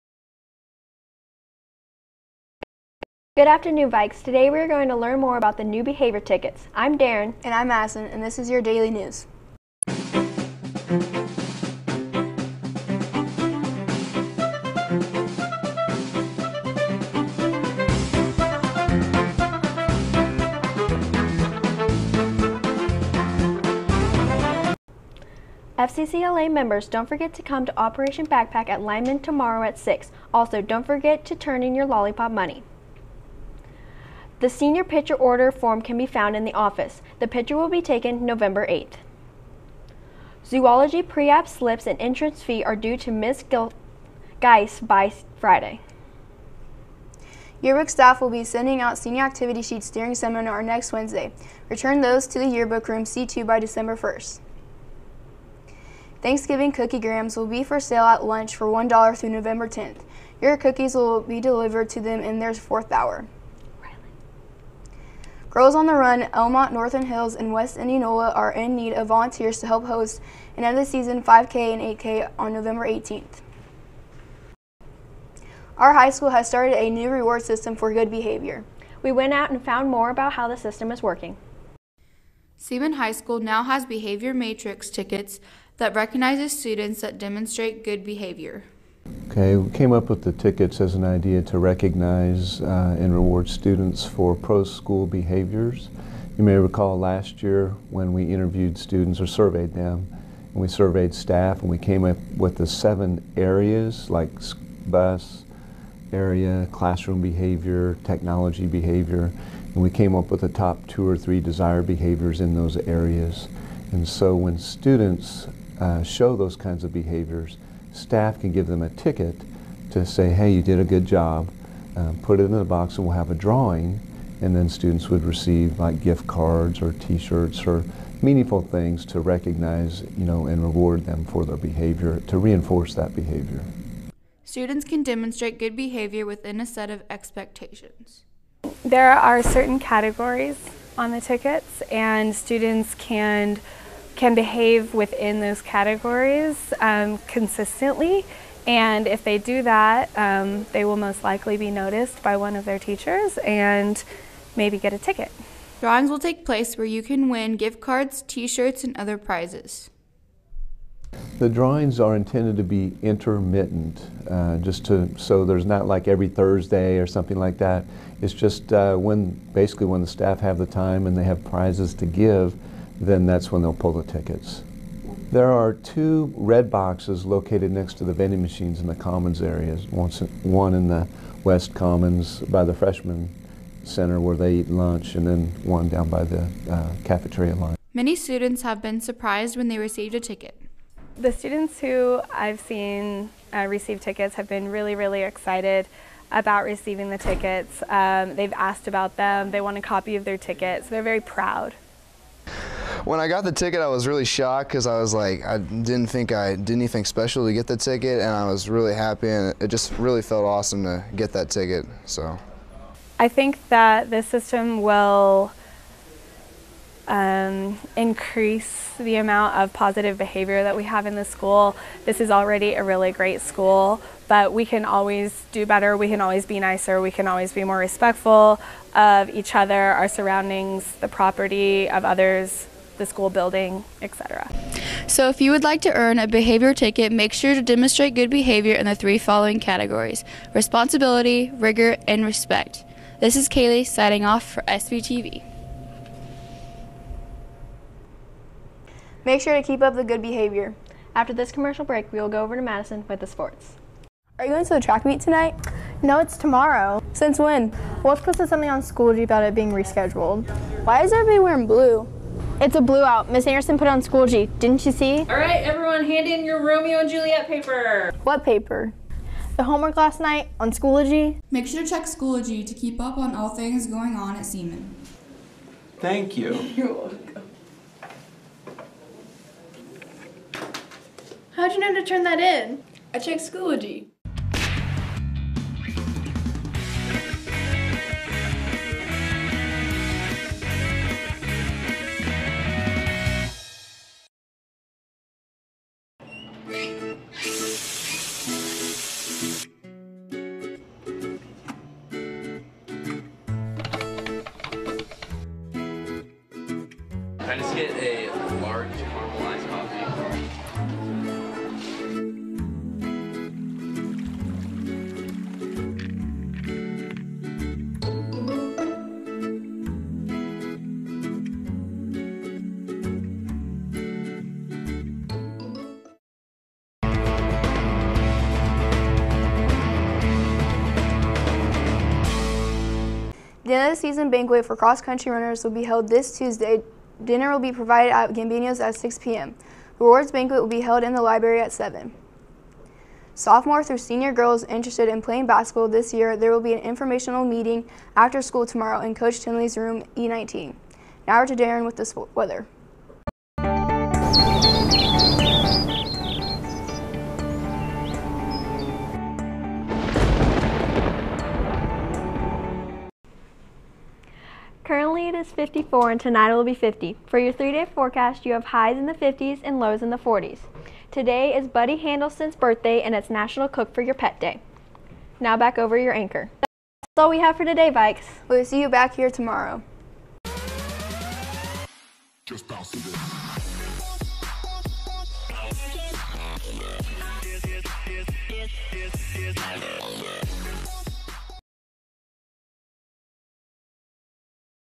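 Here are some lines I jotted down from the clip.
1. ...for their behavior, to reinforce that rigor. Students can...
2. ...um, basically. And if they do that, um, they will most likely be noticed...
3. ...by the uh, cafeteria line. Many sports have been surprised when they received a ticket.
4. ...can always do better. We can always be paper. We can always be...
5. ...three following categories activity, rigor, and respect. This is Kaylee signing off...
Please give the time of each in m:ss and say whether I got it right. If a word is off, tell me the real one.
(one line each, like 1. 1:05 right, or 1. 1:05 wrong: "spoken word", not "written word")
1. 2:11 wrong: "behavior", not "rigor"
2. 2:26 wrong: "consistently", not "basically"
3. 3:06 wrong: "students", not "sports"
4. 3:44 wrong: "nicer", not "paper"
5. 3:58 wrong: "responsibility", not "activity".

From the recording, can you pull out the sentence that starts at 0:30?
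Also, don't forget to turn in your lollipop money.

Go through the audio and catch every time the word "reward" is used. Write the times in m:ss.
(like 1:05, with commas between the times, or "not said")
1:17, 1:33, 2:10.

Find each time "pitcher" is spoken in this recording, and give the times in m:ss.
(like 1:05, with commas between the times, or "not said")
0:34.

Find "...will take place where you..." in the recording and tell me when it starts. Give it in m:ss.
2:36.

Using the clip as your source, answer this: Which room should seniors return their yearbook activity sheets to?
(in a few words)
C2.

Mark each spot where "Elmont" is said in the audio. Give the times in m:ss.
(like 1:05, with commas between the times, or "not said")
1:06.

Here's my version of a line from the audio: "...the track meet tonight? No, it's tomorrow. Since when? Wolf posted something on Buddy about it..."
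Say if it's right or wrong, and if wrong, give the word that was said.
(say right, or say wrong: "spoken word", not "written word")
wrong: "Schoology", not "Buddy".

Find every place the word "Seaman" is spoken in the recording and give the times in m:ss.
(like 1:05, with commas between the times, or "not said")
1:22, 4:34.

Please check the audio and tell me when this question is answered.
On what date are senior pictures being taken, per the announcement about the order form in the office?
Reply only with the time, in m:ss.
0:38.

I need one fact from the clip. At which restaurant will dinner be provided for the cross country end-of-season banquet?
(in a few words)
Gambino's.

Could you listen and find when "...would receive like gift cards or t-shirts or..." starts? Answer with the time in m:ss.
2:05.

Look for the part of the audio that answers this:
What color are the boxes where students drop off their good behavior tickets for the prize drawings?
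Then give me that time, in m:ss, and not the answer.
2:56.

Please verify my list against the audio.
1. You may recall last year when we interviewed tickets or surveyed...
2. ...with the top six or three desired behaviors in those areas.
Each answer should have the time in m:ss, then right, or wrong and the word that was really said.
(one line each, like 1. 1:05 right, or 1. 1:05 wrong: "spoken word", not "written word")
1. 1:36 wrong: "students", not "tickets"
2. 1:50 wrong: "two", not "six".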